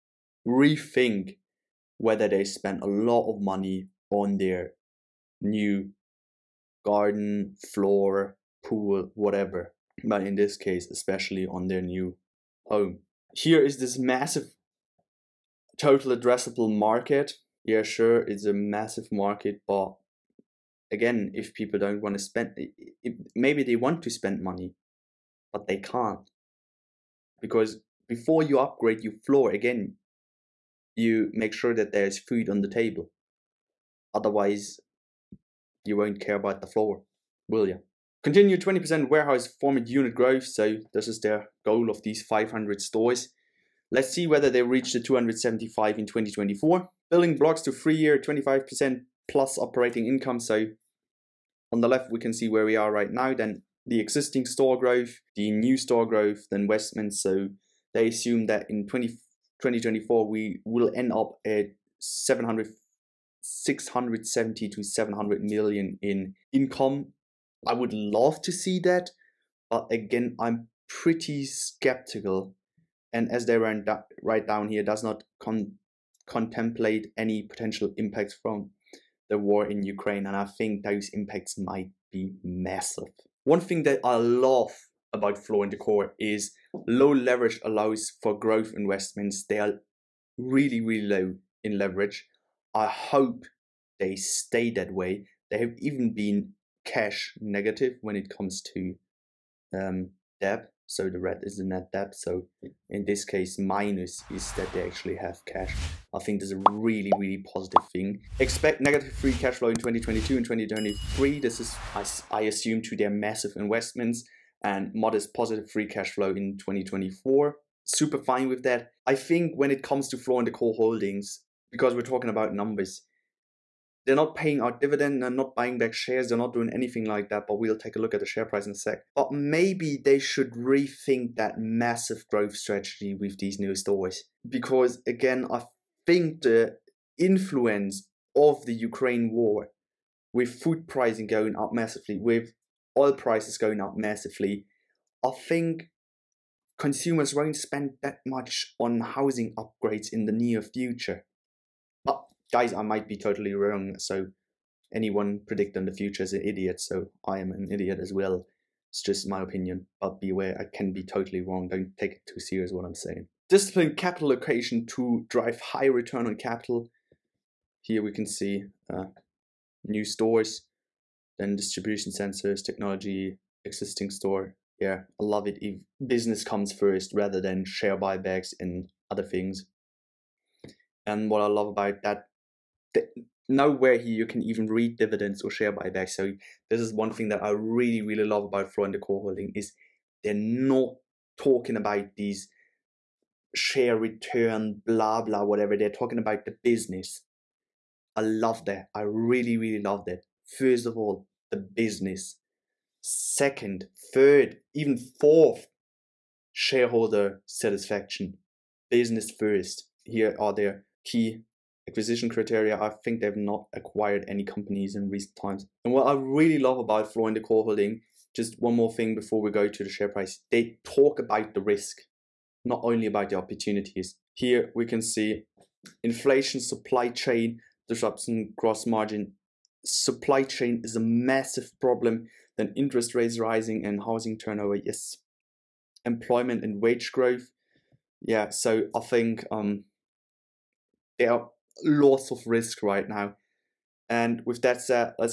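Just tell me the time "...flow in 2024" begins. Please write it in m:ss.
1:56.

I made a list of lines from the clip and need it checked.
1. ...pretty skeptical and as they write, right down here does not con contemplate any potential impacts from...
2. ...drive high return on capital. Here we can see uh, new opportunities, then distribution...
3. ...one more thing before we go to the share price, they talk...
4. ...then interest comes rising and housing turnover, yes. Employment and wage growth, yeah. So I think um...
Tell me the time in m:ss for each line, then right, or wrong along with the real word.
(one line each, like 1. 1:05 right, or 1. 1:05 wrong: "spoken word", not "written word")
1. 1:10 right
2. 2:45 wrong: "stores", not "opportunities"
3. 3:38 right
4. 3:52 wrong: "rates", not "comes".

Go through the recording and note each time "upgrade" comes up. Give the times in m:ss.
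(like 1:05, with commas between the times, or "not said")
0:28, 2:29.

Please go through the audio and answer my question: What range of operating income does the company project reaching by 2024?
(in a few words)
670 to 700 million.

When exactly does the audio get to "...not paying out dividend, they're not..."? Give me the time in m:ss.
2:04.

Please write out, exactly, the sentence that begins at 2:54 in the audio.
Yeah, I love it if business comes first rather than share buybacks and other things.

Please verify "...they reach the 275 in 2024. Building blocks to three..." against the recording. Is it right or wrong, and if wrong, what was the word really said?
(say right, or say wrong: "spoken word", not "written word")
right.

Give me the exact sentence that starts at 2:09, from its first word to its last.
But maybe they should rethink that massive growth strategy with these new stores.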